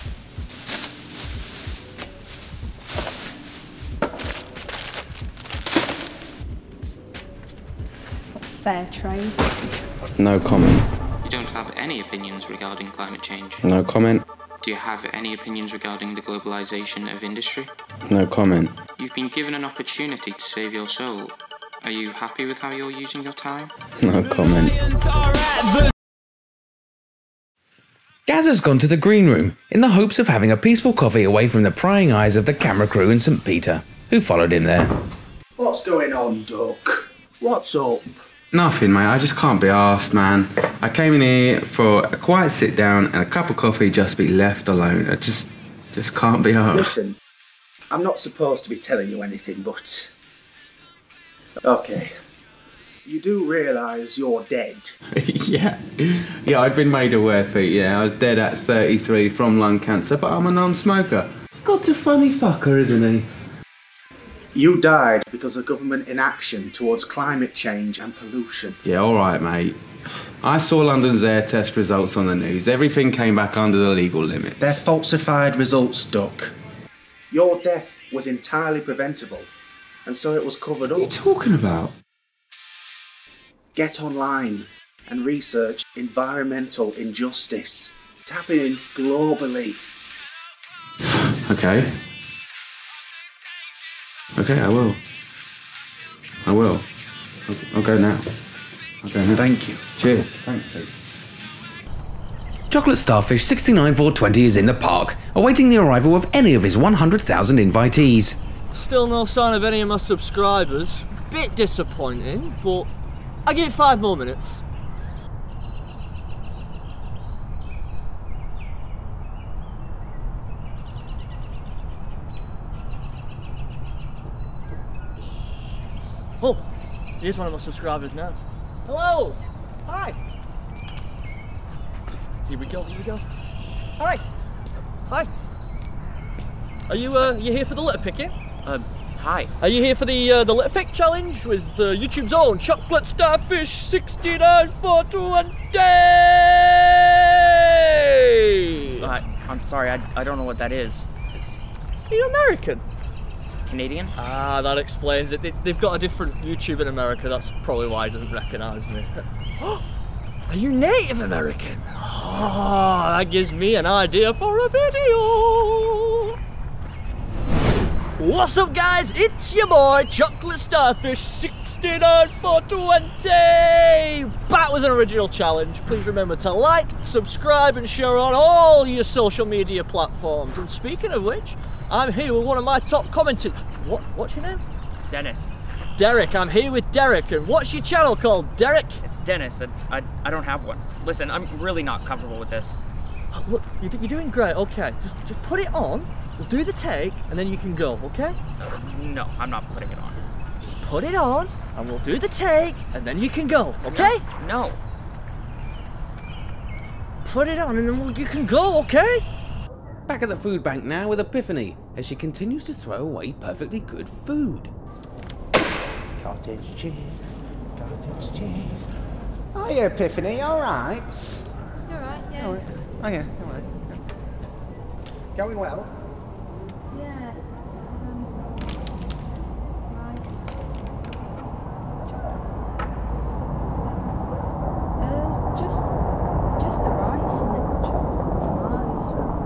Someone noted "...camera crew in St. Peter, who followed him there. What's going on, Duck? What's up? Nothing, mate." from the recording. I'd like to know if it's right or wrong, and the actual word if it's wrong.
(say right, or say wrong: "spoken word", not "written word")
right.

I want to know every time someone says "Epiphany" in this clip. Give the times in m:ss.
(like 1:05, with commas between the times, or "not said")
3:31, 3:39.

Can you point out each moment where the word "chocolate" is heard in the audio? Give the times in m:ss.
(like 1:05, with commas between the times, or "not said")
1:42, 2:22, 2:50.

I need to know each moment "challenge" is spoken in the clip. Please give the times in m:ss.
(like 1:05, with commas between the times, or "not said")
2:20, 2:55.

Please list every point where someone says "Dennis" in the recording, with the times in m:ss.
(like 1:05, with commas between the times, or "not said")
3:05, 3:09.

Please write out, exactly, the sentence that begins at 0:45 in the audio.
I just, just can't be asked.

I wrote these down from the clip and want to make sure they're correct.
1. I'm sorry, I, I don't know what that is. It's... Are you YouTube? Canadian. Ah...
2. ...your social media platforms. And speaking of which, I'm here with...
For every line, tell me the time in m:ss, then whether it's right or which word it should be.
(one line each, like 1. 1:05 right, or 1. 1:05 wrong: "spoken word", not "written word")
1. 2:29 wrong: "American", not "YouTube"
2. 2:58 right.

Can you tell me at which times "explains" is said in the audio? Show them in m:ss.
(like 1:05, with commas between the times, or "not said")
2:34.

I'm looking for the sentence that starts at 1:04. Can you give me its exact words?
You died because of government inaction towards climate change and pollution.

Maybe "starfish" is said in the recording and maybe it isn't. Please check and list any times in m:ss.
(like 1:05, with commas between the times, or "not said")
1:42, 2:23, 2:50.